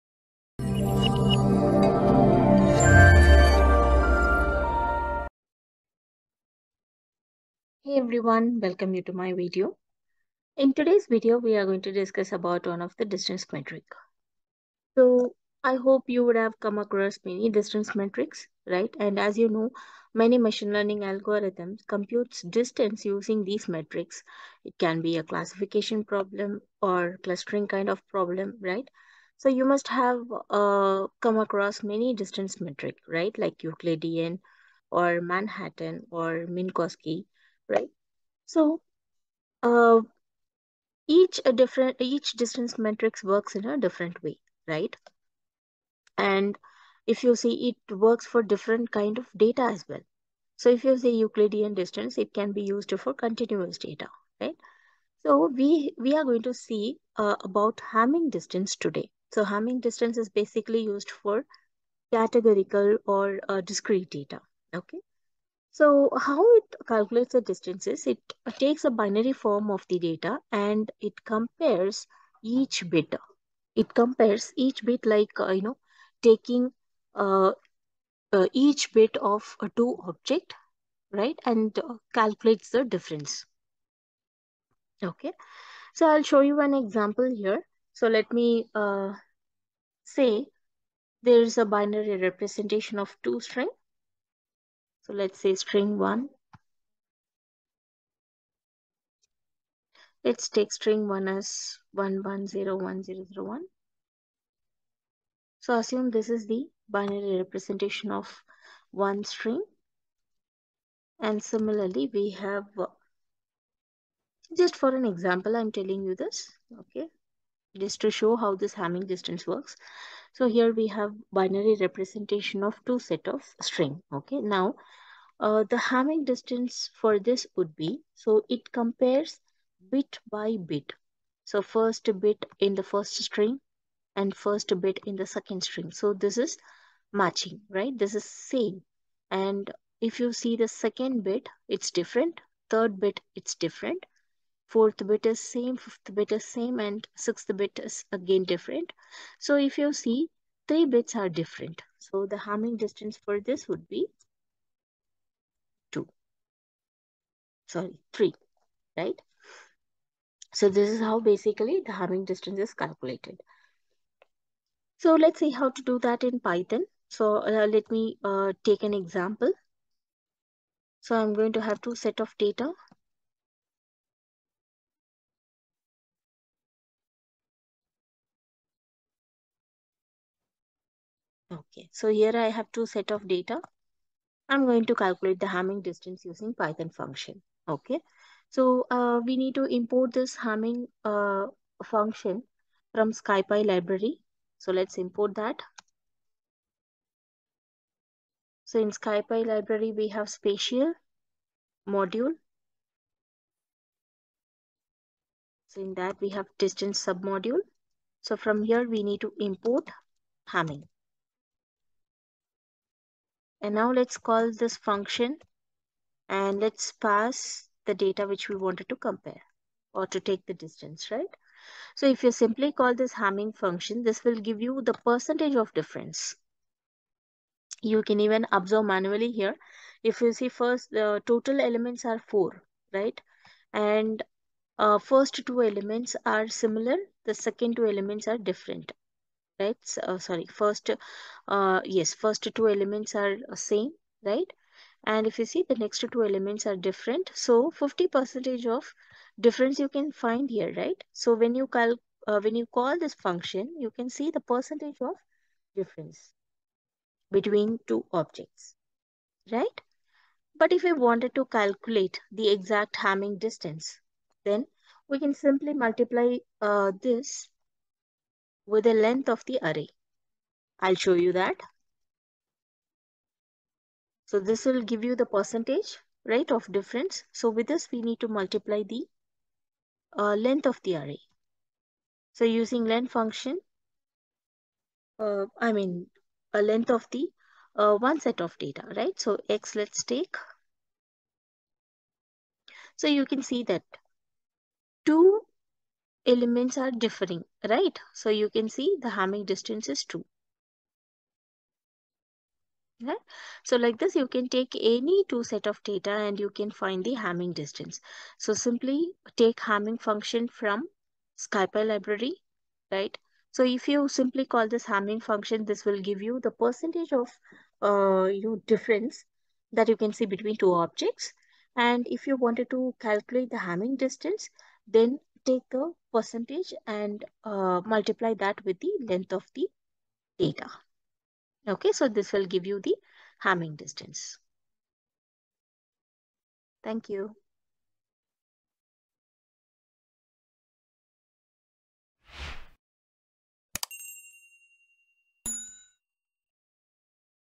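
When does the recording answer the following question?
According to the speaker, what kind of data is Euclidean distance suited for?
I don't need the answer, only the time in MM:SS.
00:53.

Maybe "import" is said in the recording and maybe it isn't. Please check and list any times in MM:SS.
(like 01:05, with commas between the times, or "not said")
03:09, 03:14, 03:29.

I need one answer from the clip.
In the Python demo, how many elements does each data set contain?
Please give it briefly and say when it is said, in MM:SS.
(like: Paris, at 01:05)
4, at 03:52.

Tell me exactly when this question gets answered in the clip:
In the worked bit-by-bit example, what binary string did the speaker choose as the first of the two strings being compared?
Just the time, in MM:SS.
01:41.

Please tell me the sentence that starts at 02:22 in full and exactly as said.
Third bit, it's different fourth bit is same, fifth bit is same, and sixth bit is again different.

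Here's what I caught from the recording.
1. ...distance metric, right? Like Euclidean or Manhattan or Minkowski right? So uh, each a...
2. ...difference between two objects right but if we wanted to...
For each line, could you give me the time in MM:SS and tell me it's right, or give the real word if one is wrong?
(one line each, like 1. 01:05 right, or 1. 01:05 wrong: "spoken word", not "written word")
1. 00:32 right
2. 04:15 right.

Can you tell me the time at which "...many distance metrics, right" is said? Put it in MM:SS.
00:17.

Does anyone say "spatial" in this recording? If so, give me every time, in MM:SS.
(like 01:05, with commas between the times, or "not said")
03:20.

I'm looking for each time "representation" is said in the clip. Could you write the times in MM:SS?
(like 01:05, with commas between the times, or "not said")
01:32, 01:47, 02:01.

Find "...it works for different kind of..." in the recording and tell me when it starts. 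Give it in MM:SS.
00:47.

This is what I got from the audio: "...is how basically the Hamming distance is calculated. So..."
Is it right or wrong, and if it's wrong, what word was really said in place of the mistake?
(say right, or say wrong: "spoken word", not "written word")
right.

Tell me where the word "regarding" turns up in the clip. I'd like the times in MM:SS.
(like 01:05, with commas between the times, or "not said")
not said.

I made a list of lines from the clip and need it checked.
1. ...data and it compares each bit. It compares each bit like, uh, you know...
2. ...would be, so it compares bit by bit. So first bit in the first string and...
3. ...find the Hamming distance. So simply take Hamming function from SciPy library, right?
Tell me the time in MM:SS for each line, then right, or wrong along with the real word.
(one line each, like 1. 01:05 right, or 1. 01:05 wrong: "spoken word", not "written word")
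1. 01:09 right
2. 02:07 right
3. 05:06 right.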